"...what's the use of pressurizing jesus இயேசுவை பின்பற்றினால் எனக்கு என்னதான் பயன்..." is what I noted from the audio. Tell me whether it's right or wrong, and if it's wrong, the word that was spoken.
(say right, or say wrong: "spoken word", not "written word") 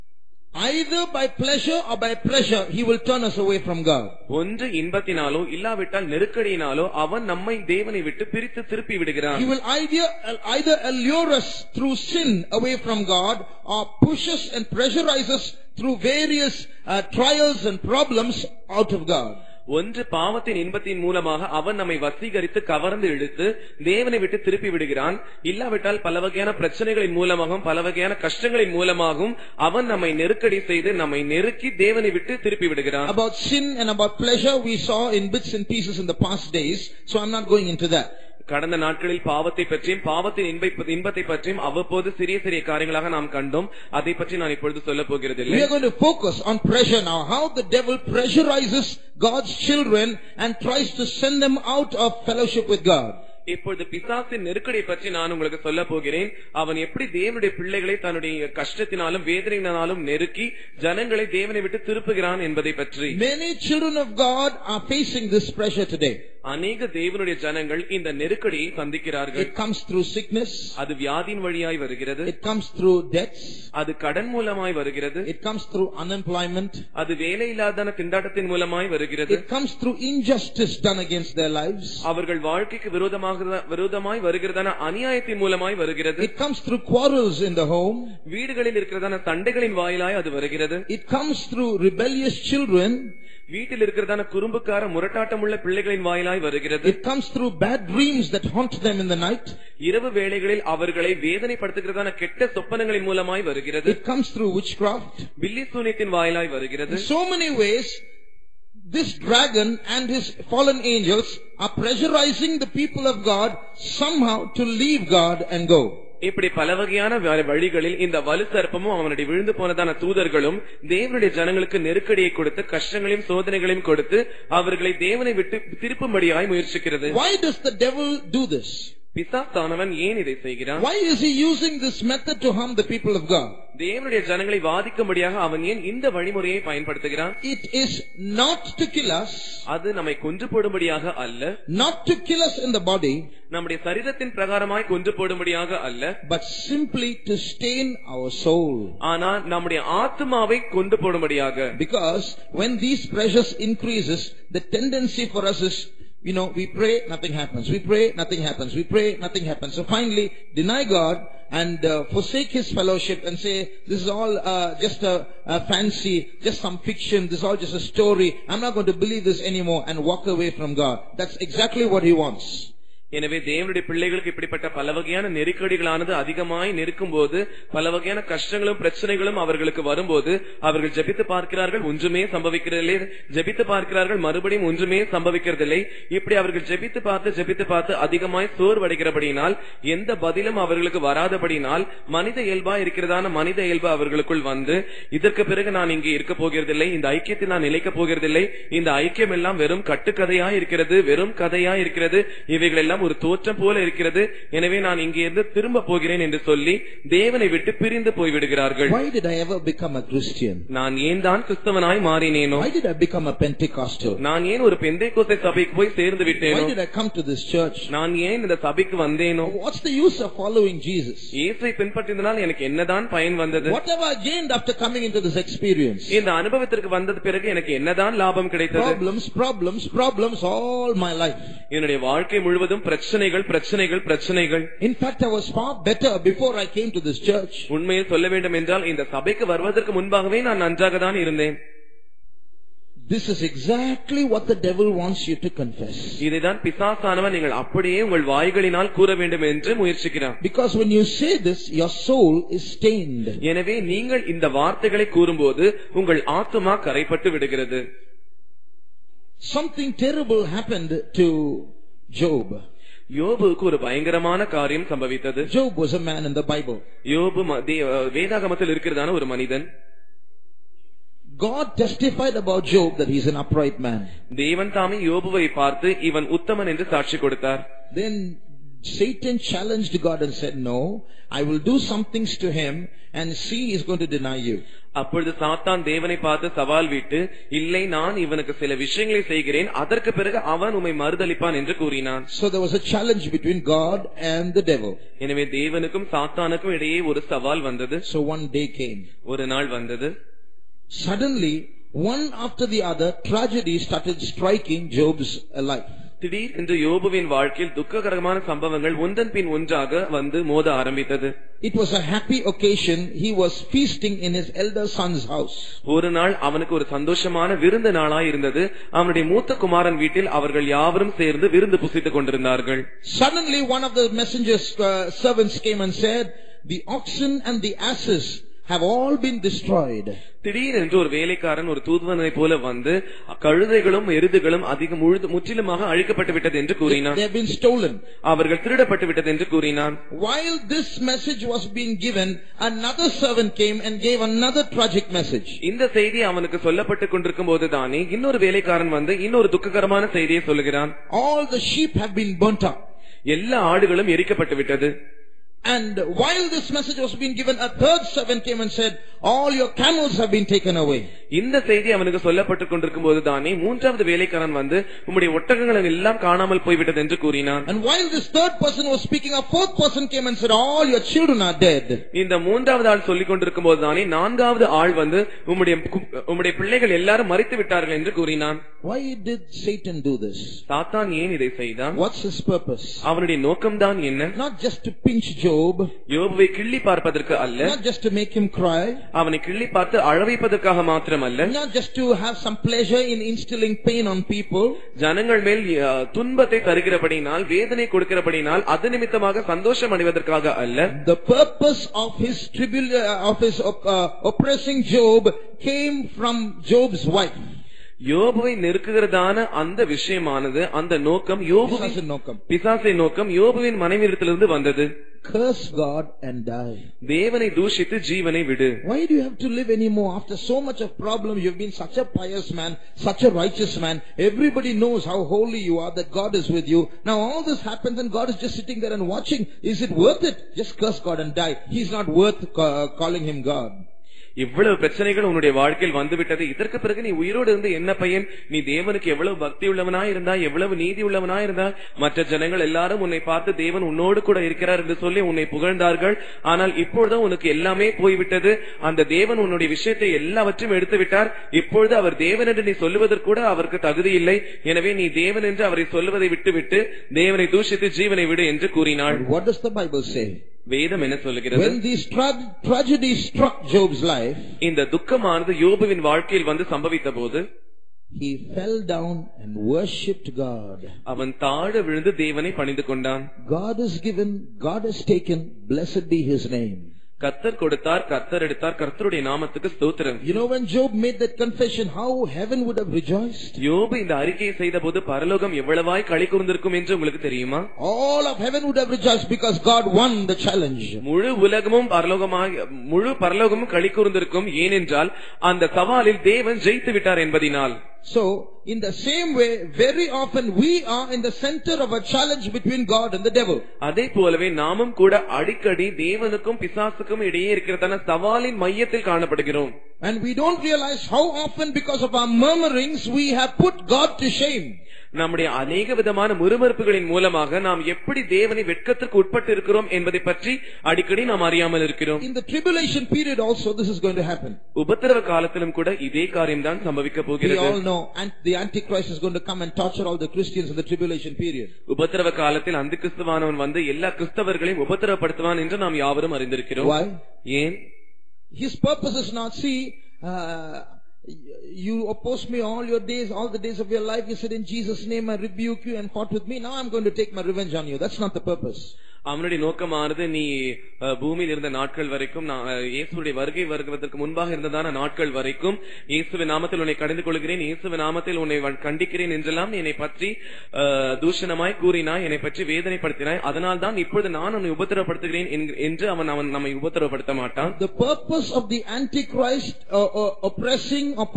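wrong: "following", not "pressurizing".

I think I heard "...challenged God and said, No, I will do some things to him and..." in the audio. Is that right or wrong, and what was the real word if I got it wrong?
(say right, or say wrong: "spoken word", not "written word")
right.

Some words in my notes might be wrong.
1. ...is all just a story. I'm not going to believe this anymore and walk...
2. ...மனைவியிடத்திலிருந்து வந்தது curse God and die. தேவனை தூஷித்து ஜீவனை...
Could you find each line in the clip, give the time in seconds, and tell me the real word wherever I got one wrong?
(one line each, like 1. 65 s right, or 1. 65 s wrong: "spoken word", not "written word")
1. 167 s right
2. 413 s right.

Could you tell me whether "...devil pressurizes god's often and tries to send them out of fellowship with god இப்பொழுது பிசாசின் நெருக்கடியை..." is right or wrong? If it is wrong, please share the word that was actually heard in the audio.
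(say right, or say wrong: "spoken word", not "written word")
wrong: "children", not "often".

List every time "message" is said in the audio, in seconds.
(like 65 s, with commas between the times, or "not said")
341 s, 345 s, 356 s.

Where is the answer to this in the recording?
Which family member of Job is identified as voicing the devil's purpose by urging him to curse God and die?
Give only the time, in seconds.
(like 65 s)
406 s.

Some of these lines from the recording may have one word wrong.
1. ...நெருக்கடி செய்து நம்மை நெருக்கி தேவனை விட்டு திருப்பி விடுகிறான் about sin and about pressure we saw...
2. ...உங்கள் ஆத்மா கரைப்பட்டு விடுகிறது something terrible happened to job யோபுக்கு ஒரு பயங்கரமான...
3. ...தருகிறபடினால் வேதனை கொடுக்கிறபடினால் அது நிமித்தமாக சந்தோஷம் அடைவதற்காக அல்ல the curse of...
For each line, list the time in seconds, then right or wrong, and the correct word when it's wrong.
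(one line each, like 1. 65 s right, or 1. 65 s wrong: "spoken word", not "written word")
1. 30 s wrong: "pleasure", not "pressure"
2. 256 s right
3. 396 s wrong: "purpose", not "curse".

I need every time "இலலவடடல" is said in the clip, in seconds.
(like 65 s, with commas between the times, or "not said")
5 s, 25 s.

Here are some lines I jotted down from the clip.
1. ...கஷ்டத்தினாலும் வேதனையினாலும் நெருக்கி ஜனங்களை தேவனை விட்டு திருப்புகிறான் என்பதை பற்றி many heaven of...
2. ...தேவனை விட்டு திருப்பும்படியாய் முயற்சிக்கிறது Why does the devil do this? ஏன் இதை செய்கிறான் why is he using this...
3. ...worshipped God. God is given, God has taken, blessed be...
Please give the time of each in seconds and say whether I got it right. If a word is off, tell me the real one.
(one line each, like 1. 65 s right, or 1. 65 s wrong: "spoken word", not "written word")
1. 58 s wrong: "children", not "heaven"
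2. 125 s right
3. 469 s right.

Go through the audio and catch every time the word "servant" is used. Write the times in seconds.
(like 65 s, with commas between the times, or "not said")
343 s, 358 s.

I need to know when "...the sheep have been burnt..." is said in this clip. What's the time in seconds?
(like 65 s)
351 s.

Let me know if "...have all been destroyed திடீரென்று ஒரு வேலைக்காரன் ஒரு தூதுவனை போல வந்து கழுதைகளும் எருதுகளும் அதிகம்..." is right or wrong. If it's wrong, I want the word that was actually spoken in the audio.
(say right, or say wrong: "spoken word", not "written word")
right.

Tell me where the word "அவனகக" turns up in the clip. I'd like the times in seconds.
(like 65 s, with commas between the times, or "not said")
316 s, 346 s, 361 s.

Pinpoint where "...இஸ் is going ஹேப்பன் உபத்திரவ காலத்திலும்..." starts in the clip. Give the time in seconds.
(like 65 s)
523 s.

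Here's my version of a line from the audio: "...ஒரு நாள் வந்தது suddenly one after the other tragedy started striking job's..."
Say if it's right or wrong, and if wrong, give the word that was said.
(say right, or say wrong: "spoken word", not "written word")
right.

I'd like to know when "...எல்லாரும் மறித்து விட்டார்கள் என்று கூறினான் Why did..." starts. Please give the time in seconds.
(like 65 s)
376 s.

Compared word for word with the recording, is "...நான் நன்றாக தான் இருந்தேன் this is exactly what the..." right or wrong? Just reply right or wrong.
right.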